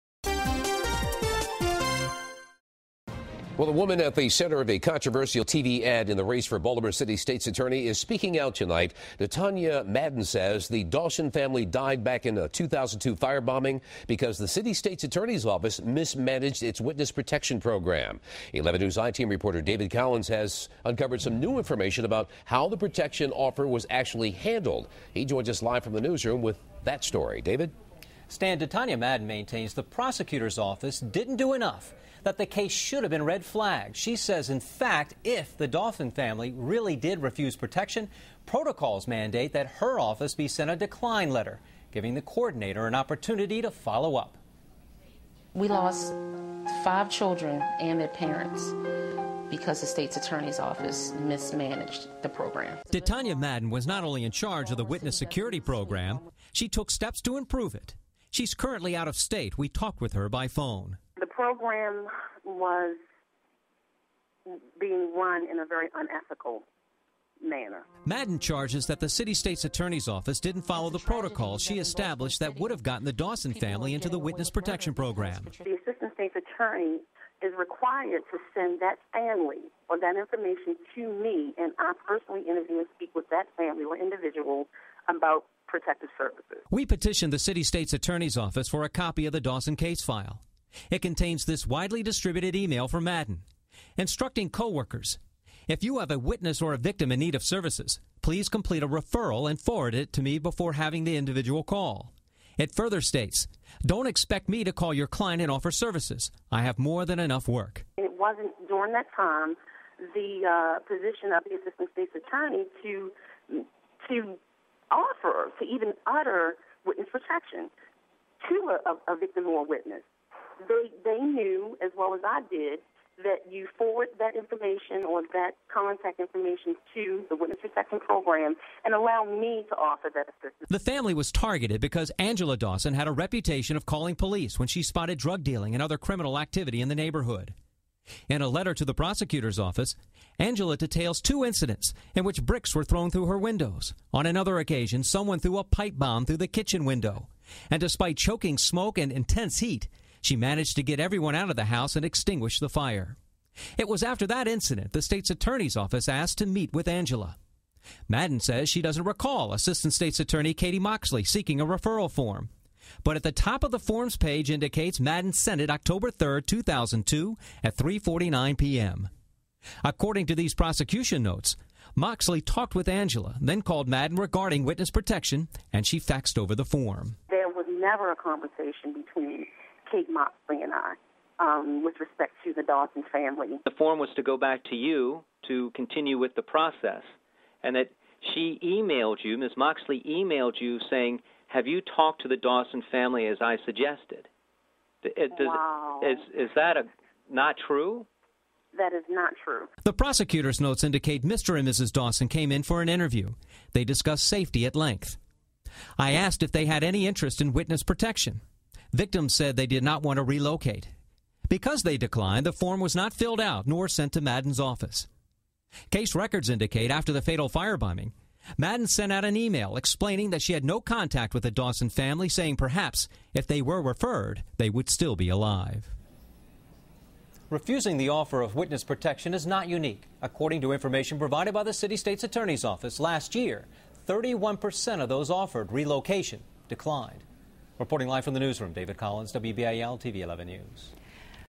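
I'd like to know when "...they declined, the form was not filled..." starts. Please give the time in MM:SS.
03:31.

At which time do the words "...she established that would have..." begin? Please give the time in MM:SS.
01:11.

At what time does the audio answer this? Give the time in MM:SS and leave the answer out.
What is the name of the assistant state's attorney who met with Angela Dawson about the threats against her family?
02:40.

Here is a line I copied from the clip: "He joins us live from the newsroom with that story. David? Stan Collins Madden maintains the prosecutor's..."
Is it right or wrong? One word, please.
wrong.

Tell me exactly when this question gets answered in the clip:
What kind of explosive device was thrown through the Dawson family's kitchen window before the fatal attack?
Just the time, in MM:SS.
02:25.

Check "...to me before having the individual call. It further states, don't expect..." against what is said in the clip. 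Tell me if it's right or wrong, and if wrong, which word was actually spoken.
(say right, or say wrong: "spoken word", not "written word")
right.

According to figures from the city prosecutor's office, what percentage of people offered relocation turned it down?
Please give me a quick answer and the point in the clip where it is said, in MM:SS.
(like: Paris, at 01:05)
31%, at 03:54.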